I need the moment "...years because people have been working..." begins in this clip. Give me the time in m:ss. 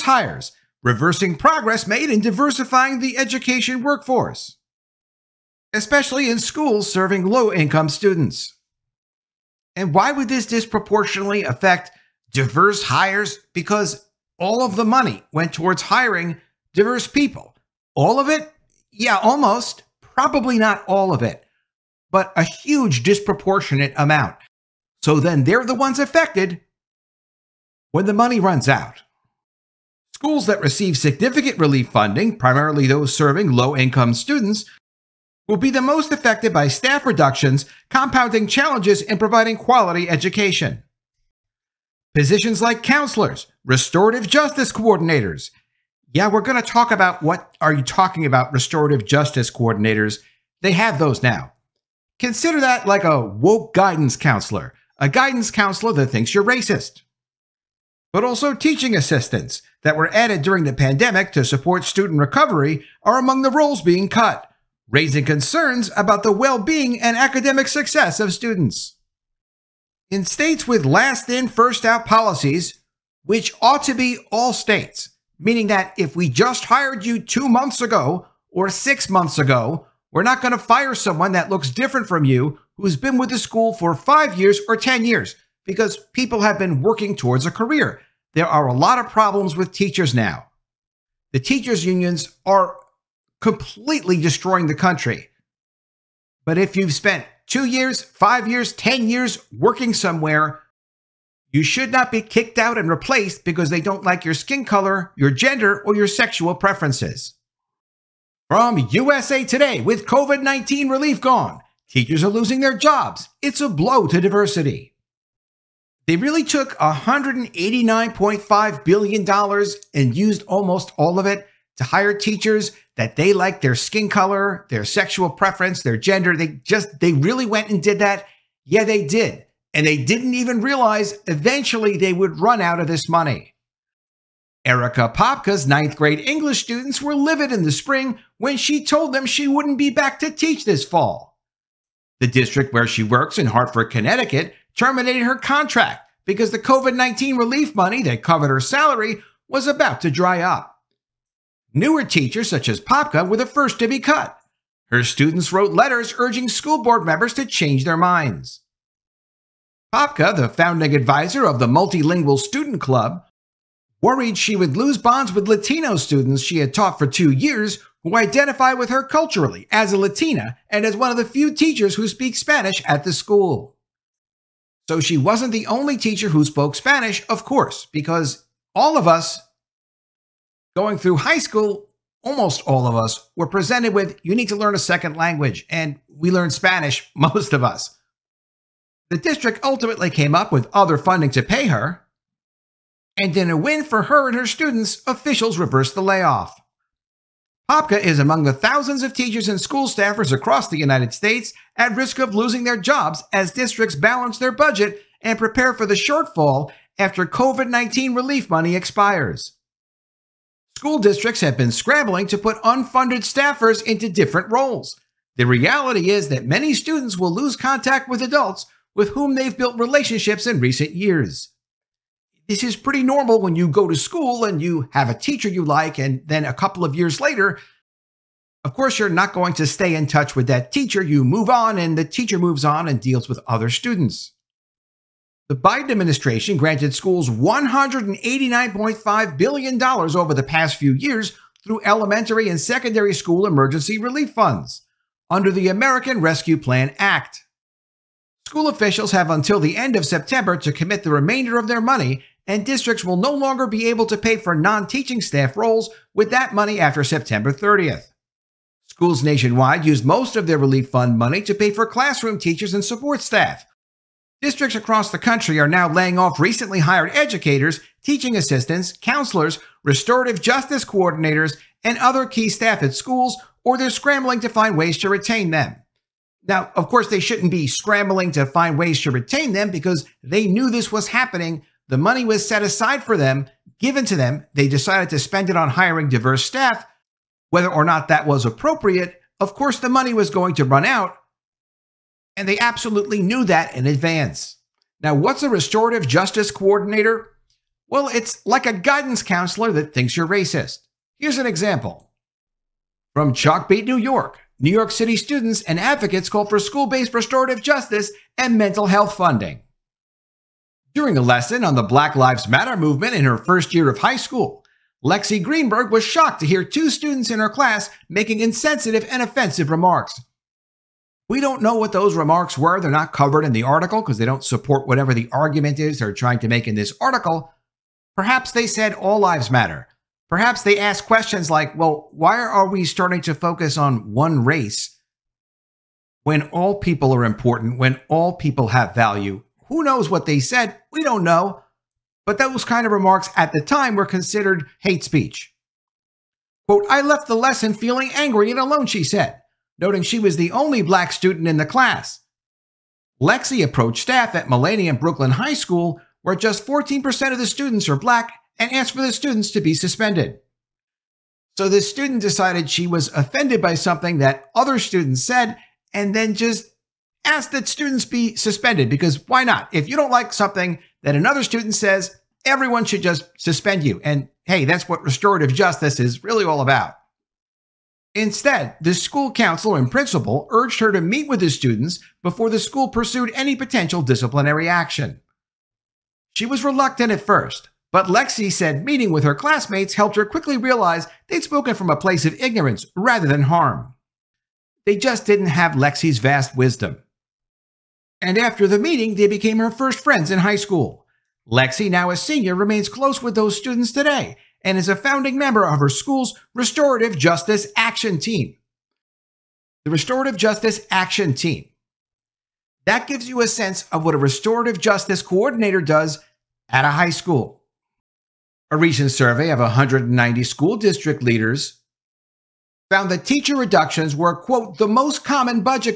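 1:25.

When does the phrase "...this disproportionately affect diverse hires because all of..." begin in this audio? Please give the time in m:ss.
0:10.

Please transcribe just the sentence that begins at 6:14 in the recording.
And hey, that's what restorative justice is really all about.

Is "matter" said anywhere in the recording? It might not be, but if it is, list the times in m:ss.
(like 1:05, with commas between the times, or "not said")
5:12, 5:29.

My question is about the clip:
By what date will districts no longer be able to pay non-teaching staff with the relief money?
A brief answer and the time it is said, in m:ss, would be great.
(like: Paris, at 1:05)
September 30th, at 4:17.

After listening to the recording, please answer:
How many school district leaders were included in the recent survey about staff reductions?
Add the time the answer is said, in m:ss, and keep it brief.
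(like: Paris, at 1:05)
190, at 6:59.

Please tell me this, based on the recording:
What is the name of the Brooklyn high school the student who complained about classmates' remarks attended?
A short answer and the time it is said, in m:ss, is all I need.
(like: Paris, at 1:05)
Millennium Brooklyn High School, at 5:54.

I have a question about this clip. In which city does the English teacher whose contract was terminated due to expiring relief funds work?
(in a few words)
Hartford, Connecticut.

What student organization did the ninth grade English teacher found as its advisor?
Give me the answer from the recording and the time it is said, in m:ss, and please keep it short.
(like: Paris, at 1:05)
Multilingual Student Club, at 2:41.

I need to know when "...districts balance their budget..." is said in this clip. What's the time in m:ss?
3:23.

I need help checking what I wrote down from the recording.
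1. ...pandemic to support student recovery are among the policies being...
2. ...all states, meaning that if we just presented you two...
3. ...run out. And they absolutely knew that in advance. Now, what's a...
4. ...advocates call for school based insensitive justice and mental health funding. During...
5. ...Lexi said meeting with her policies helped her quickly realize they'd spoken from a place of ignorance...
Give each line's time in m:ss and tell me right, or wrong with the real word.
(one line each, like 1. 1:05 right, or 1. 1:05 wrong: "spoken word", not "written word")
1. 1:00 wrong: "roles", not "policies"
2. 1:14 wrong: "hired", not "presented"
3. 4:50 right
4. 5:05 wrong: "restorative", not "insensitive"
5. 6:28 wrong: "classmates", not "policies".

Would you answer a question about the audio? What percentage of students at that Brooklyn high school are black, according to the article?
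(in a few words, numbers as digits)
14%.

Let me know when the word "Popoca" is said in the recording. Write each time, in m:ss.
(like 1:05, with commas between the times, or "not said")
2:15, 2:32, 2:39, 3:17.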